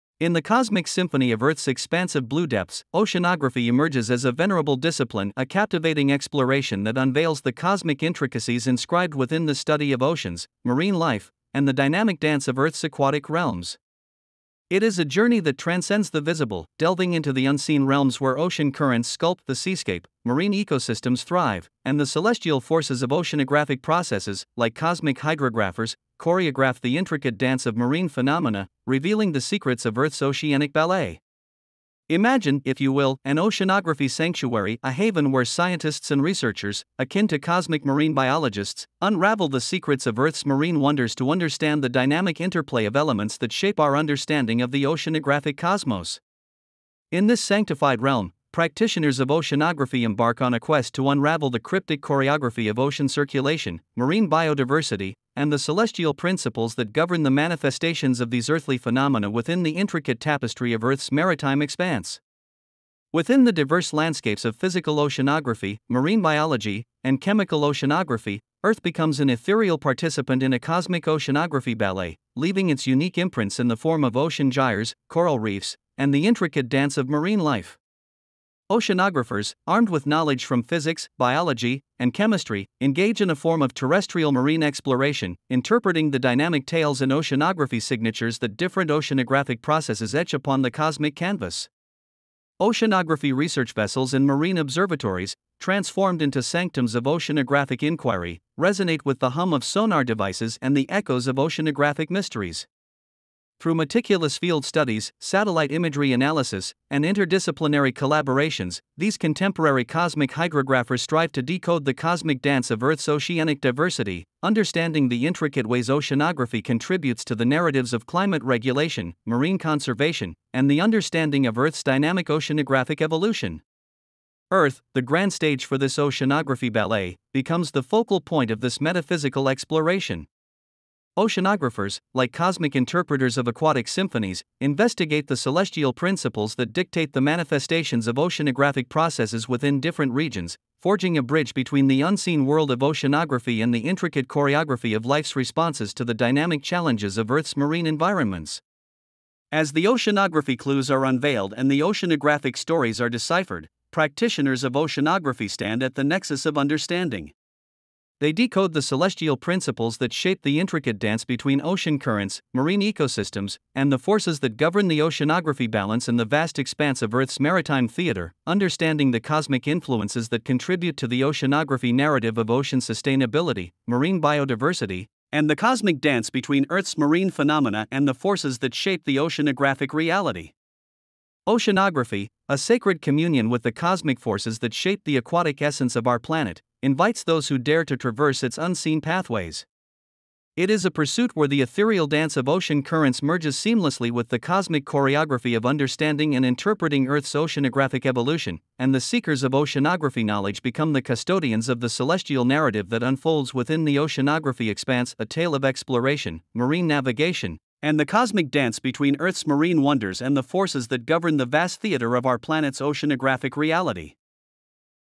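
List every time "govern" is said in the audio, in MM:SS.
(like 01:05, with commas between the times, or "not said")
00:56, 02:44, 03:31.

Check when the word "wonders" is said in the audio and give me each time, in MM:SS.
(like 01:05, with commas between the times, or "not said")
00:40, 03:29.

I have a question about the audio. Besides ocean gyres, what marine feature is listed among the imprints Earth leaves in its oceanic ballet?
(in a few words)
coral reefs.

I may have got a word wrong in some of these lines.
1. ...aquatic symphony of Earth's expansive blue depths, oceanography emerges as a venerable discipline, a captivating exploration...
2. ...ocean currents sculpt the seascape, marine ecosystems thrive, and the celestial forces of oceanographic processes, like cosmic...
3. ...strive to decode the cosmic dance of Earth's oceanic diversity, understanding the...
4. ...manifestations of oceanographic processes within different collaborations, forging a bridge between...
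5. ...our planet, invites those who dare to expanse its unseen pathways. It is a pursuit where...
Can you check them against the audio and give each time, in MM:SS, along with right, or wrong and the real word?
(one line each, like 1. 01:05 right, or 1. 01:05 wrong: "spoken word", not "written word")
1. 00:00 wrong: "cosmic", not "aquatic"
2. 00:18 right
3. 01:51 right
4. 02:17 wrong: "regions", not "collaborations"
5. 03:06 wrong: "traverse", not "expanse".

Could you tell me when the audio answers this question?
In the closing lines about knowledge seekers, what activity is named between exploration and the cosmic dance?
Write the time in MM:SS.
03:26.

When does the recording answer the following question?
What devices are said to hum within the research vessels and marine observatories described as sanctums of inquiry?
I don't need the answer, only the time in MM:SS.
01:39.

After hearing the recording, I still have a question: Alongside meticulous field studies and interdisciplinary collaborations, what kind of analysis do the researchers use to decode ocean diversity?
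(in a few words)
satellite imagery analysis.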